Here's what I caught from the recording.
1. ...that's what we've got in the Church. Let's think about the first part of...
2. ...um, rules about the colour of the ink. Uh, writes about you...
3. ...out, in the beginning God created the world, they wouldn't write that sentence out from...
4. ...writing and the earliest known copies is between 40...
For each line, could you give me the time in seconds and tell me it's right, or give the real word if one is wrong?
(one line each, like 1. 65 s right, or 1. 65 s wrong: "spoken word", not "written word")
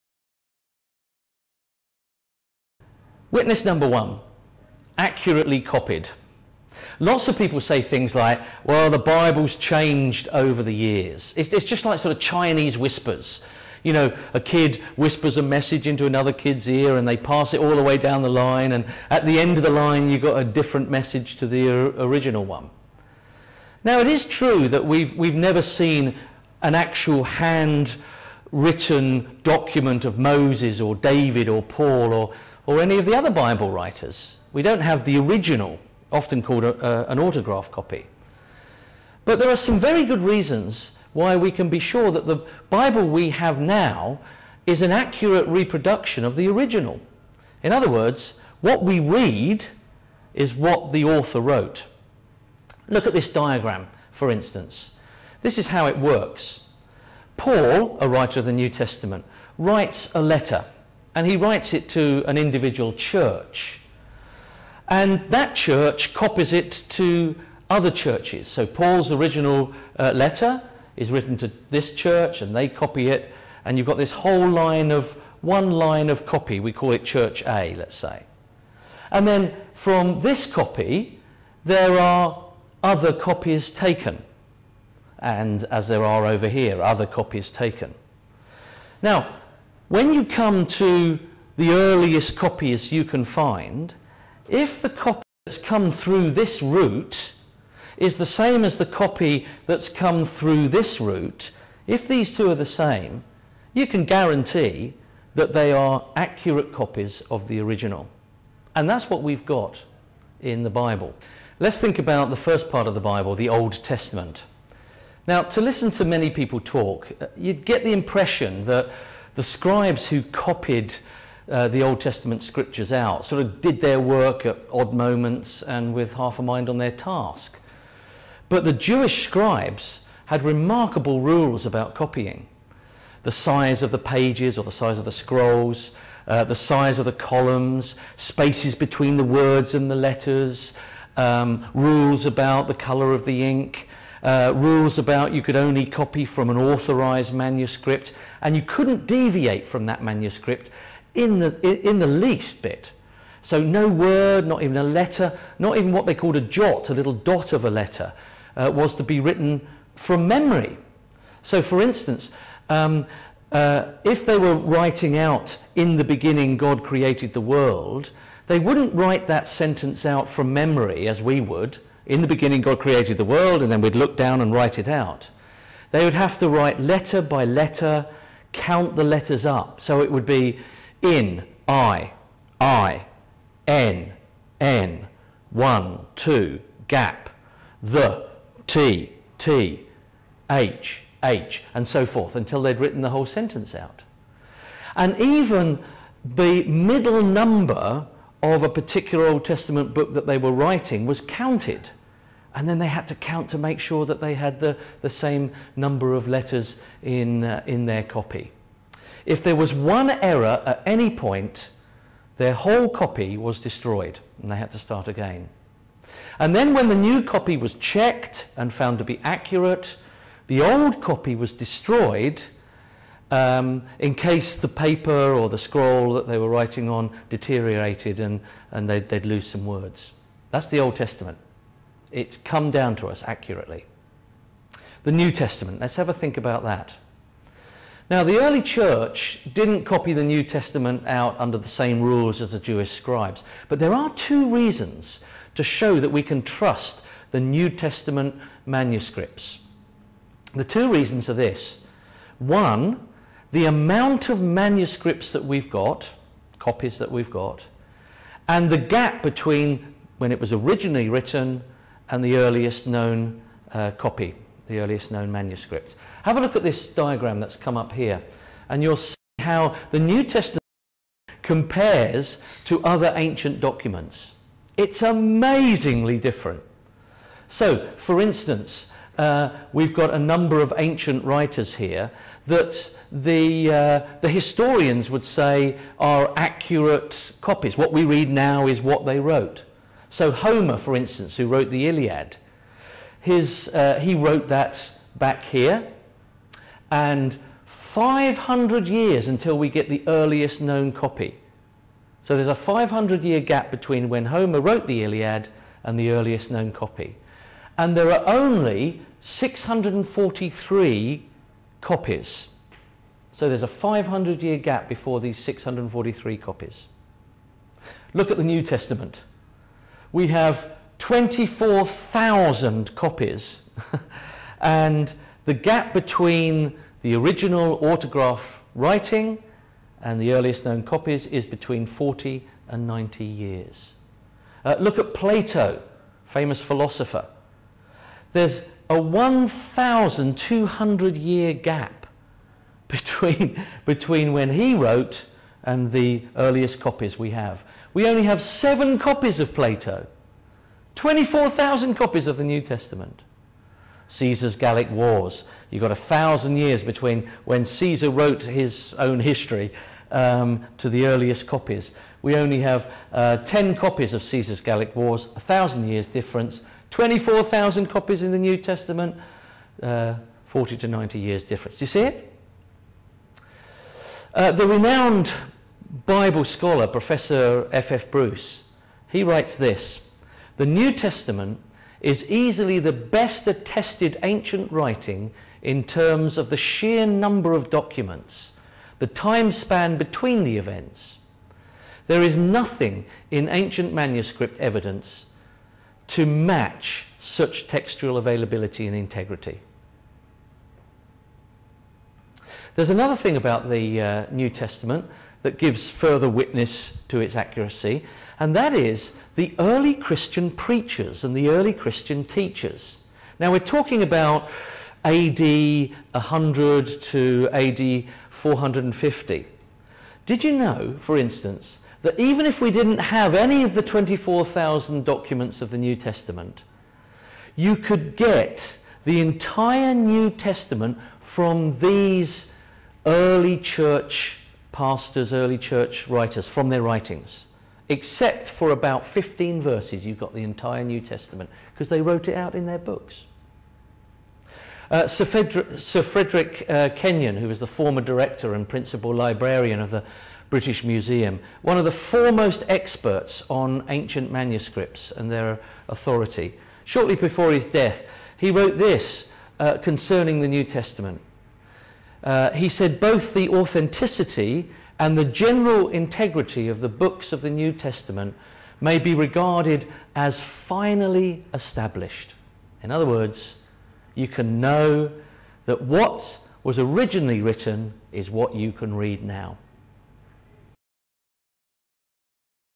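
1. 108 s wrong: "Bible", not "Church"
2. 141 s wrong: "rules", not "writes"
3. 165 s right
4. 328 s right.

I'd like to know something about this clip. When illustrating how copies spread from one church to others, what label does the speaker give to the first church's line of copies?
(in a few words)
Church A.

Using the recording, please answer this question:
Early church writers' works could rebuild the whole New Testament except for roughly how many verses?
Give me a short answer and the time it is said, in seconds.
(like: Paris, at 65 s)
15, at 439 s.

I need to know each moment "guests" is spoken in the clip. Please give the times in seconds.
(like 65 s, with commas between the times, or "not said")
not said.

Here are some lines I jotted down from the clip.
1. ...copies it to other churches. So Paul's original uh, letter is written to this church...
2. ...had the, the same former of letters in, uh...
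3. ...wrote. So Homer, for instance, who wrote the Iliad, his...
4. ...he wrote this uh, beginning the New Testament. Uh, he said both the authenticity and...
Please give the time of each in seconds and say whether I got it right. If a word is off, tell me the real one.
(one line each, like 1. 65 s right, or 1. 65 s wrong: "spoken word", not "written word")
1. 66 s right
2. 204 s wrong: "number", not "former"
3. 289 s right
4. 458 s wrong: "concerning", not "beginning".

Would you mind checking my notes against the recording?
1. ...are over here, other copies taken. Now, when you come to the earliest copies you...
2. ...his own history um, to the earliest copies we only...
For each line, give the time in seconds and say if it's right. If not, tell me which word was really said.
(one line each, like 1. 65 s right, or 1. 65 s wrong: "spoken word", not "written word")
1. 86 s right
2. 358 s right.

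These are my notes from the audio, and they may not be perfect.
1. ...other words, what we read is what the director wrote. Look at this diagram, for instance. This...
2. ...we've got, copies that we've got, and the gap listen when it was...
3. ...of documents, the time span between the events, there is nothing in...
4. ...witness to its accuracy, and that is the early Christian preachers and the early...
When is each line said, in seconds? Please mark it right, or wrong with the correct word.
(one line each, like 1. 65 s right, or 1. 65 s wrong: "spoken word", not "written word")
1. 47 s wrong: "author", not "director"
2. 255 s wrong: "between", not "listen"
3. 387 s right
4. 406 s right.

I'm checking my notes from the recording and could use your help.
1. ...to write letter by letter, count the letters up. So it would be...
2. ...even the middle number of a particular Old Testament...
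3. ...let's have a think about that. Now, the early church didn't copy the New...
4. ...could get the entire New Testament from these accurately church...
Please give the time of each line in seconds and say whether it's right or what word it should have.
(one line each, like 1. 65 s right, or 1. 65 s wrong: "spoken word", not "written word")
1. 176 s right
2. 195 s right
3. 235 s right
4. 427 s wrong: "early", not "accurately".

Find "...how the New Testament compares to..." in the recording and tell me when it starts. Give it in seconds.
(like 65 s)
269 s.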